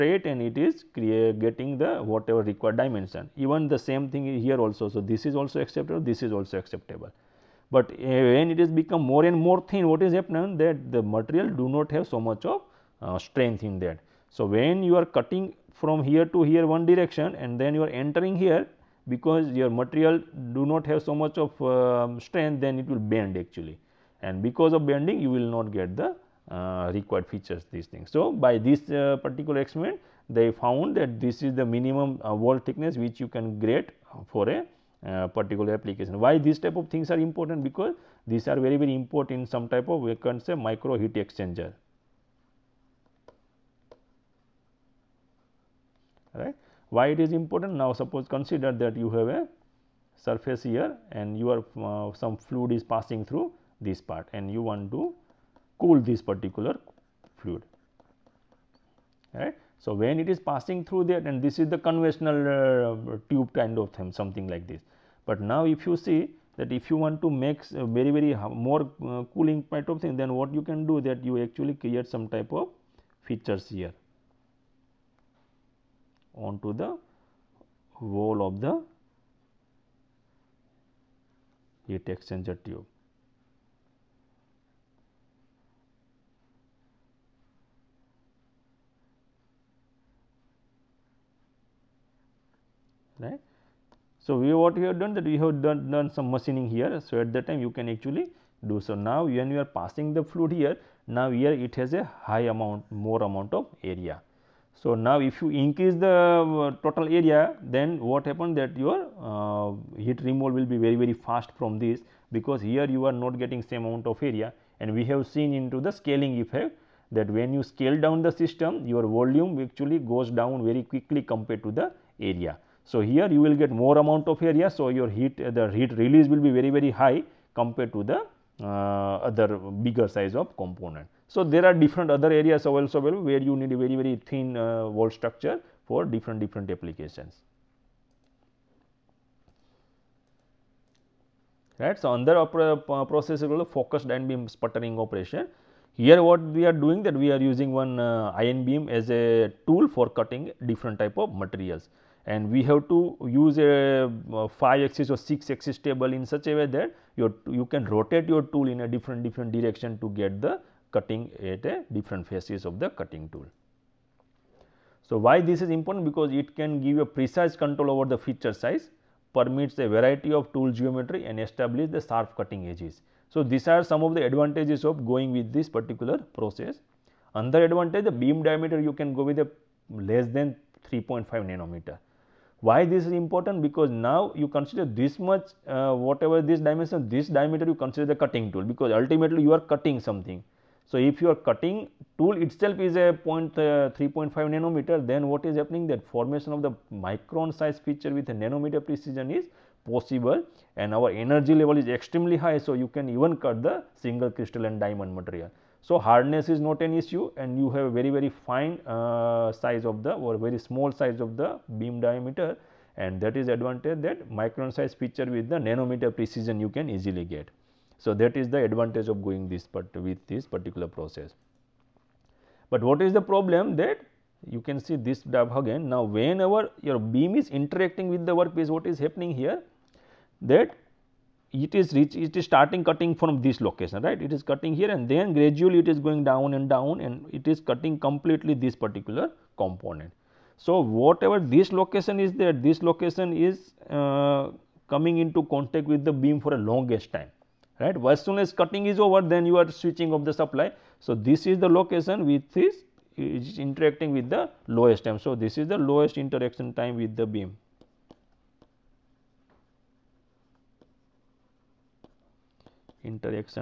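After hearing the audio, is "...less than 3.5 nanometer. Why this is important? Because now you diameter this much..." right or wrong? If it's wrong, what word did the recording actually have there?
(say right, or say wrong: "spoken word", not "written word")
wrong: "consider", not "diameter".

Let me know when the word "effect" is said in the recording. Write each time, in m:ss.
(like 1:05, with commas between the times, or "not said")
1:56.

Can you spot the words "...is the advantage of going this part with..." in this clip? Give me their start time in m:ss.
3:38.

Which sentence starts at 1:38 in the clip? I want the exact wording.
So, now when you are passing the fluid here, now here it has a high amount more amount of area.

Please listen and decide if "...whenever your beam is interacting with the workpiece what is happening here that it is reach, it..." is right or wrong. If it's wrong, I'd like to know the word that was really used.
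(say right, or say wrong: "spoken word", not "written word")
right.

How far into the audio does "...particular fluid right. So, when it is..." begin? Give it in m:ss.
0:56.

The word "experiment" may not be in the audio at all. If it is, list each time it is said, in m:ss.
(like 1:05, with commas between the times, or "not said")
0:29.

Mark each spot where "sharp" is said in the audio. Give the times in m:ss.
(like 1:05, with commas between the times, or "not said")
2:52.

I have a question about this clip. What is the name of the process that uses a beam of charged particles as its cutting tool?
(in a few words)
focused ion beam sputtering.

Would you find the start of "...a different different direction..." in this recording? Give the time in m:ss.
2:38.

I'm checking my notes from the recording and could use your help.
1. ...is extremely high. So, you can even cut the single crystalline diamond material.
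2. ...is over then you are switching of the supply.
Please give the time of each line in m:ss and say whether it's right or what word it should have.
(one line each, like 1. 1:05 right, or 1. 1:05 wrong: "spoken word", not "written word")
1. 3:21 right
2. 4:08 right.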